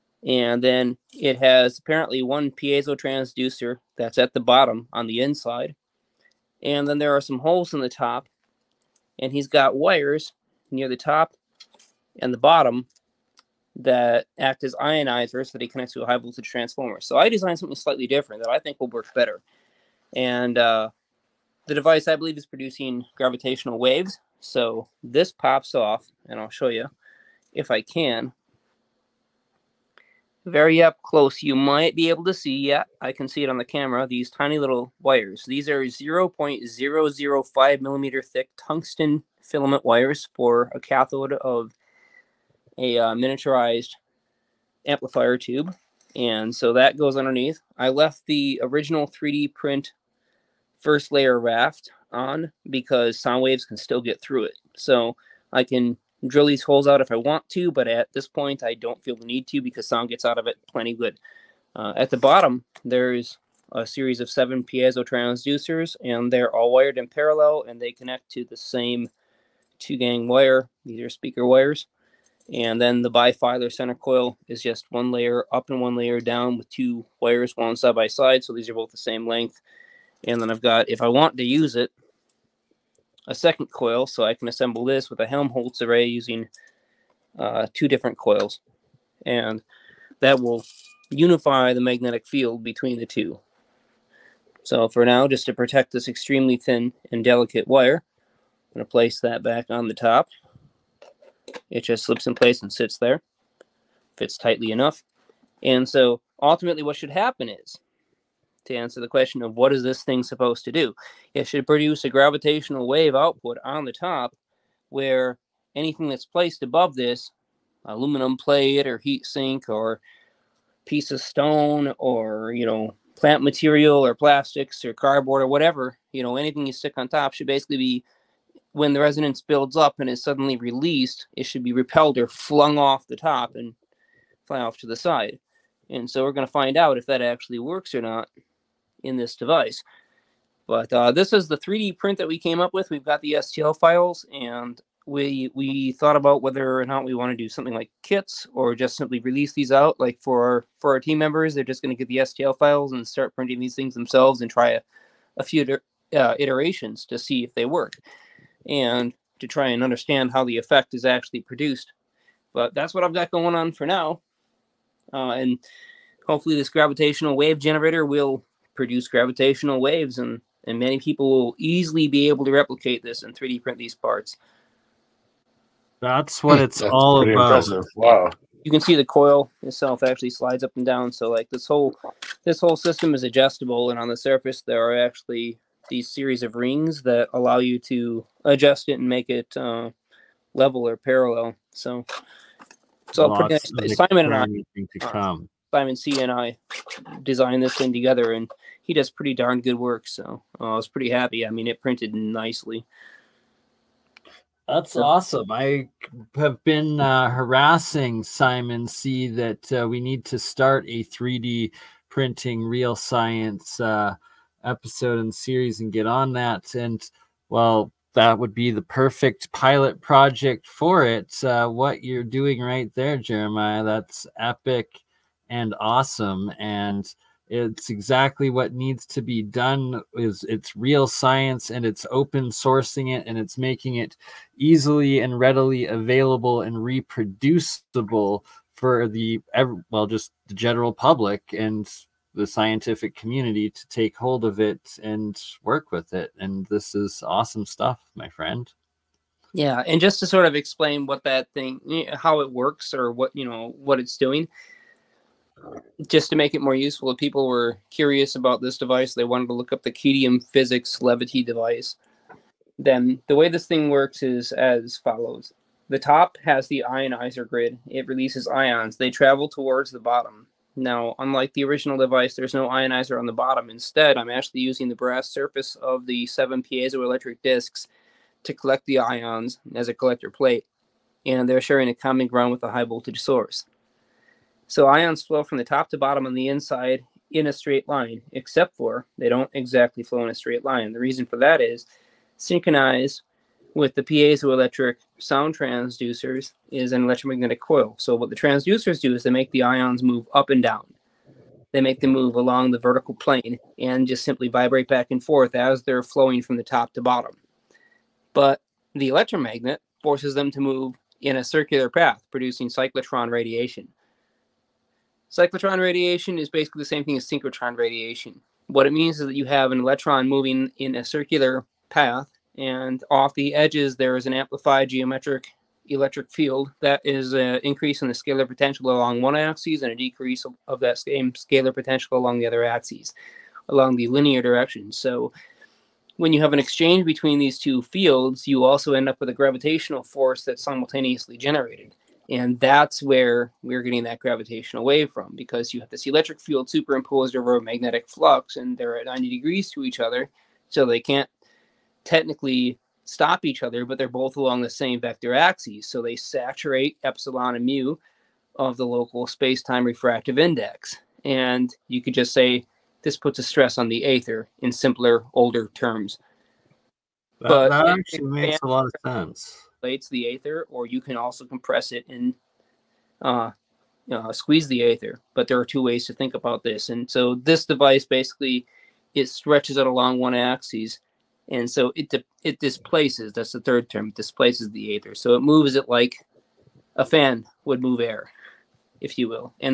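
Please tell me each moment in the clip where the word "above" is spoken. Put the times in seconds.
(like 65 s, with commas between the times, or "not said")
116 s.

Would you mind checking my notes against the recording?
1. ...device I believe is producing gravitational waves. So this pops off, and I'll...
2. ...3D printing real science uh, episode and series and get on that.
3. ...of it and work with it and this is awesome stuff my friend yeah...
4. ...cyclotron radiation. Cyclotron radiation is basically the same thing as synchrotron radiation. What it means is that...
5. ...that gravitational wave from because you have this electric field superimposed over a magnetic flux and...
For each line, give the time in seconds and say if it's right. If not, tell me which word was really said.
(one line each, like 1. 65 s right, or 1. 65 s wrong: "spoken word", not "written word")
1. 21 s right
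2. 211 s right
3. 244 s right
4. 312 s right
5. 344 s right.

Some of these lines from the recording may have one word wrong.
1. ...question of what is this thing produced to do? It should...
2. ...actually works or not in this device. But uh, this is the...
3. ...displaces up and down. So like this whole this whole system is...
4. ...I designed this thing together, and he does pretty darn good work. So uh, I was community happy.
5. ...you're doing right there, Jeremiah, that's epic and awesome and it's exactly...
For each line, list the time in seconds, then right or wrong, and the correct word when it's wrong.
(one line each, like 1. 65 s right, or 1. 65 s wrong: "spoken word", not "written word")
1. 109 s wrong: "supposed", not "produced"
2. 137 s right
3. 180 s wrong: "slides", not "displaces"
4. 196 s wrong: "pretty", not "community"
5. 222 s right.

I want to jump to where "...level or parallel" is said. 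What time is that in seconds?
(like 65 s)
190 s.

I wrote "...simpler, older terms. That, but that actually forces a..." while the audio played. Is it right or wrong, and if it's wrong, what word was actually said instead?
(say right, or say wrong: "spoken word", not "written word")
wrong: "makes", not "forces".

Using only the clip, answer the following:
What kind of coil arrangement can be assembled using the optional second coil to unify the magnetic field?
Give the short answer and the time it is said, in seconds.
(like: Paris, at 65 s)
Helmholtz array, at 85 s.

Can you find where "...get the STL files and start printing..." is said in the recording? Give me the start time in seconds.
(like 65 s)
152 s.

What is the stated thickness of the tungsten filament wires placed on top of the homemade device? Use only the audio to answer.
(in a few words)
0.005 millimeter.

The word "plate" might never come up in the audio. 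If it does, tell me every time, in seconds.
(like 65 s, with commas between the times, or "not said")
118 s, 280 s.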